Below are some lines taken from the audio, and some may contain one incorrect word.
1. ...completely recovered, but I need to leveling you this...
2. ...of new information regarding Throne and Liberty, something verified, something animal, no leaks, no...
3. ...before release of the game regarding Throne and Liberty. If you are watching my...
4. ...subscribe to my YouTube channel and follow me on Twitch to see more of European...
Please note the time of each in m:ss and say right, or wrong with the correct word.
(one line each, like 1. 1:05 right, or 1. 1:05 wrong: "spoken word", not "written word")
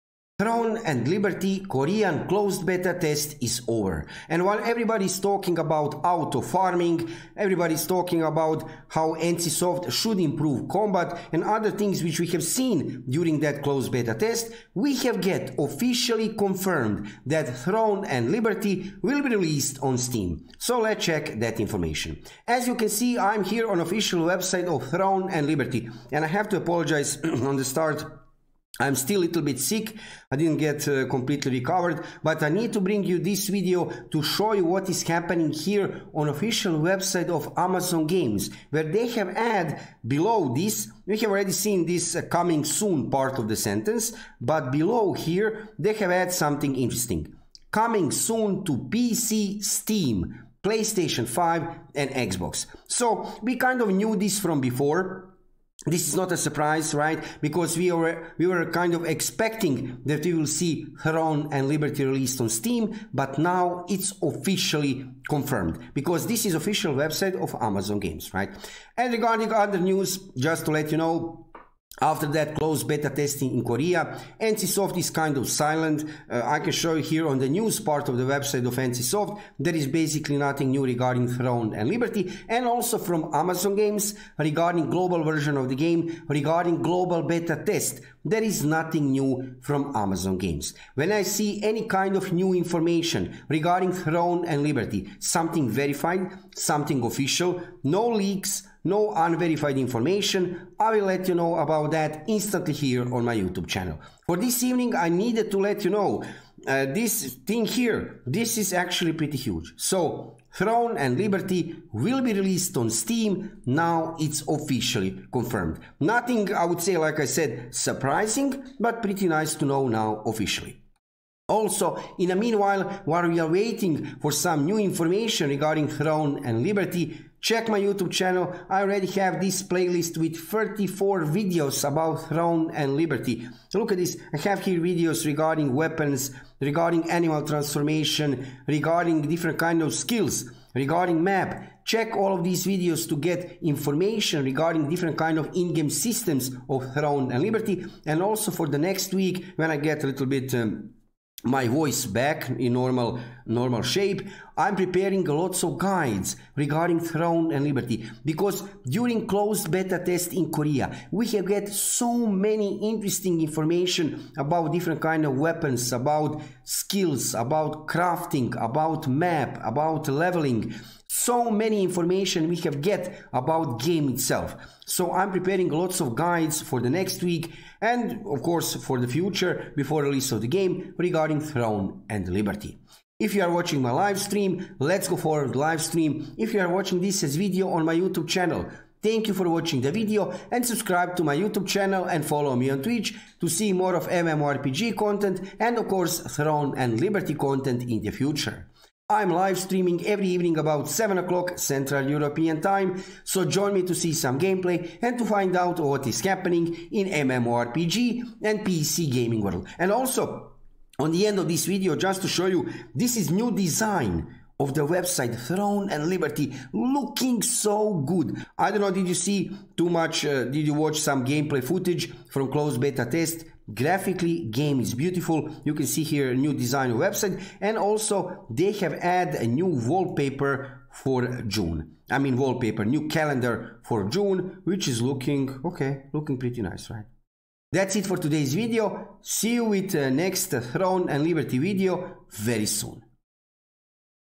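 1. 0:31 wrong: "bring", not "leveling"
2. 1:32 wrong: "official", not "animal"
3. 2:59 right
4. 3:10 wrong: "MMORPG", not "European".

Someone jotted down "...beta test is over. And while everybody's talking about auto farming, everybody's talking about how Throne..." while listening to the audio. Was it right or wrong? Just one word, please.
wrong.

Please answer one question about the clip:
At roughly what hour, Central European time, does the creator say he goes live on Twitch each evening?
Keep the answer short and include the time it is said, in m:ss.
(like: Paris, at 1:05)
7 o'clock, at 3:20.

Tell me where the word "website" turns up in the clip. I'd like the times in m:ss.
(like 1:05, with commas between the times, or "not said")
0:24, 0:36, 1:06, 1:18, 3:34, 3:46.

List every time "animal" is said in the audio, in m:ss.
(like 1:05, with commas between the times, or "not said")
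2:17.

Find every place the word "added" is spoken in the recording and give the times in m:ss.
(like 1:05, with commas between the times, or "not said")
0:46, 3:48.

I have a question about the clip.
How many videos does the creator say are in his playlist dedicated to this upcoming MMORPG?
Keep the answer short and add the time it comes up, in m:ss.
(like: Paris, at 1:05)
34, at 2:10.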